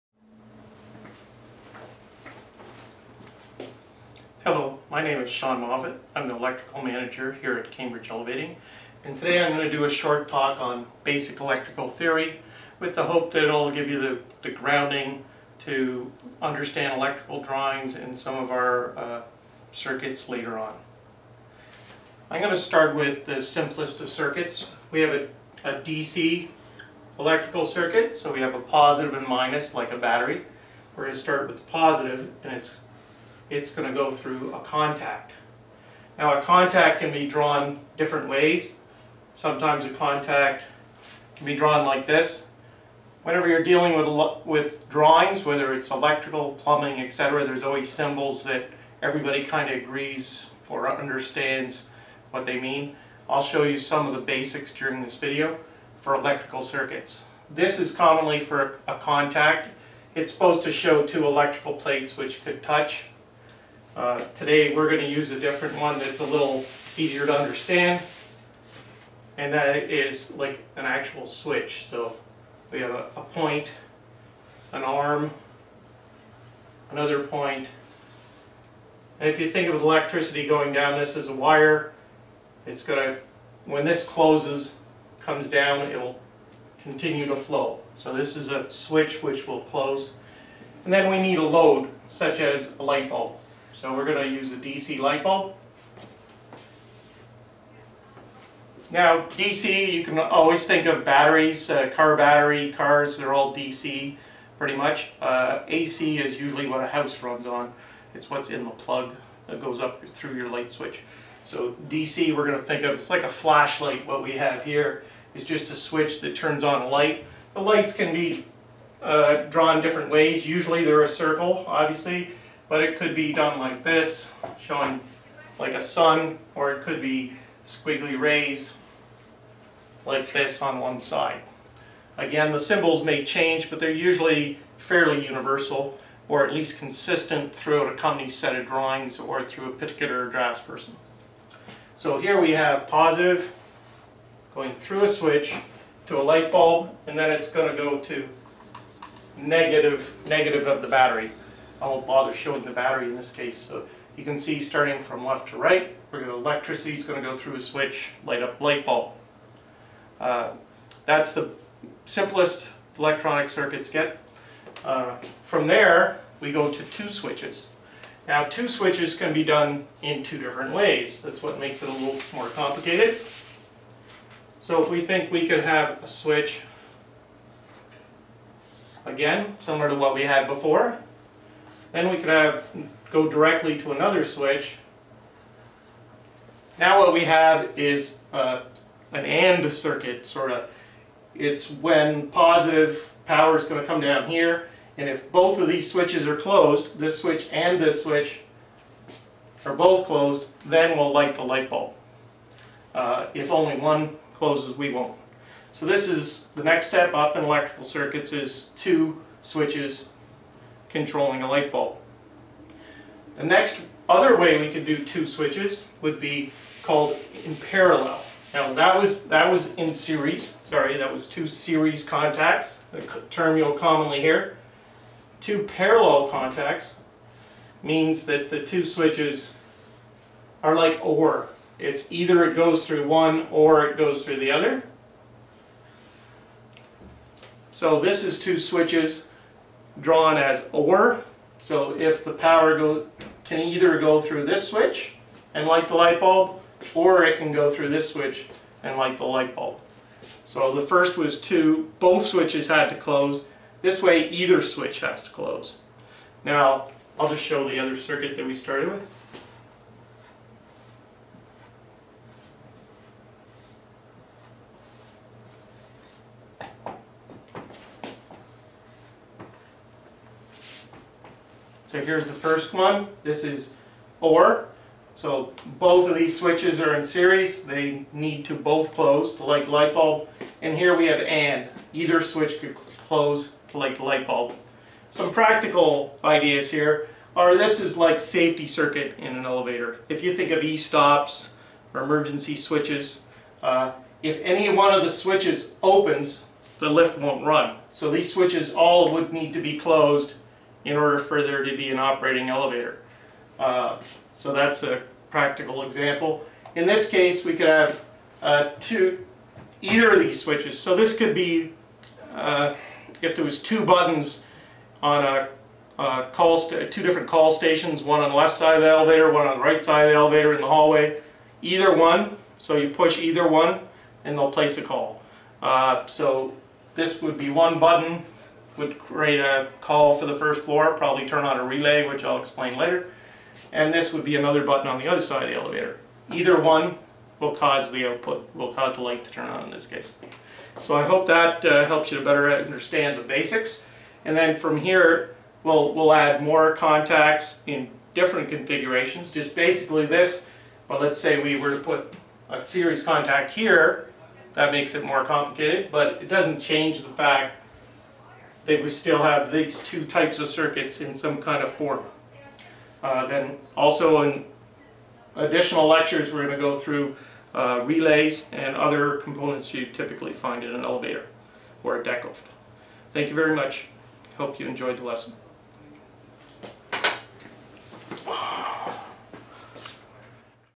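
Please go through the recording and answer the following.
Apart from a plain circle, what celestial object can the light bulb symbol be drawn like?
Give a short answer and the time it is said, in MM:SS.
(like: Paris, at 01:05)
A sun, at 02:05.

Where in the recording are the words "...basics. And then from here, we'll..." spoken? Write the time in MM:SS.
05:43.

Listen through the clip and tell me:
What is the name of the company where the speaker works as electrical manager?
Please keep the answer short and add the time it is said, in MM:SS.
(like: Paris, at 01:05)
Cambridge Elevating, at 00:07.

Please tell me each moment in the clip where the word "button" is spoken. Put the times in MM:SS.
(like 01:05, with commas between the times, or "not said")
05:13, 05:27, 05:34.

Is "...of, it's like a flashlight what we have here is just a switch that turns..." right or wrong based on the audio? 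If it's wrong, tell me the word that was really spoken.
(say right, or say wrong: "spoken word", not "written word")
right.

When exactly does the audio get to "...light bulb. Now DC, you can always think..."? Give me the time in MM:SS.
01:34.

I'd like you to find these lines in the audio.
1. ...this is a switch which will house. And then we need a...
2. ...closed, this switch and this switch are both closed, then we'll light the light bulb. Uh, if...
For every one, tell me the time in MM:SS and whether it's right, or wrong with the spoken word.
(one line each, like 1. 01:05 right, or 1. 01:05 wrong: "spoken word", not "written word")
1. 01:28 wrong: "close", not "house"
2. 03:16 right.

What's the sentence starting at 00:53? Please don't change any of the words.
I'll show you some of the basics during this video for electrical circuits.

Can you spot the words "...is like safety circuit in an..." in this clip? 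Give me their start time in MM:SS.
04:47.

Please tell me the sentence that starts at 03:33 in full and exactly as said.
The next other way we could do two switches would be called in parallel.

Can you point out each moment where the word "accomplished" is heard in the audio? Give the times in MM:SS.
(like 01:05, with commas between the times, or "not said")
not said.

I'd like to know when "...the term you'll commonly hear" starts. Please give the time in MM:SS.
03:42.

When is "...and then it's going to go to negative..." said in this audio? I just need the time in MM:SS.
02:27.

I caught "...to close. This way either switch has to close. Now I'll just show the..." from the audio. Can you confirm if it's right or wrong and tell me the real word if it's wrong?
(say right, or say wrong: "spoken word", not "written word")
right.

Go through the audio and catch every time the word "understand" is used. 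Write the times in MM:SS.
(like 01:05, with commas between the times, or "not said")
00:16, 00:50, 01:07, 05:42.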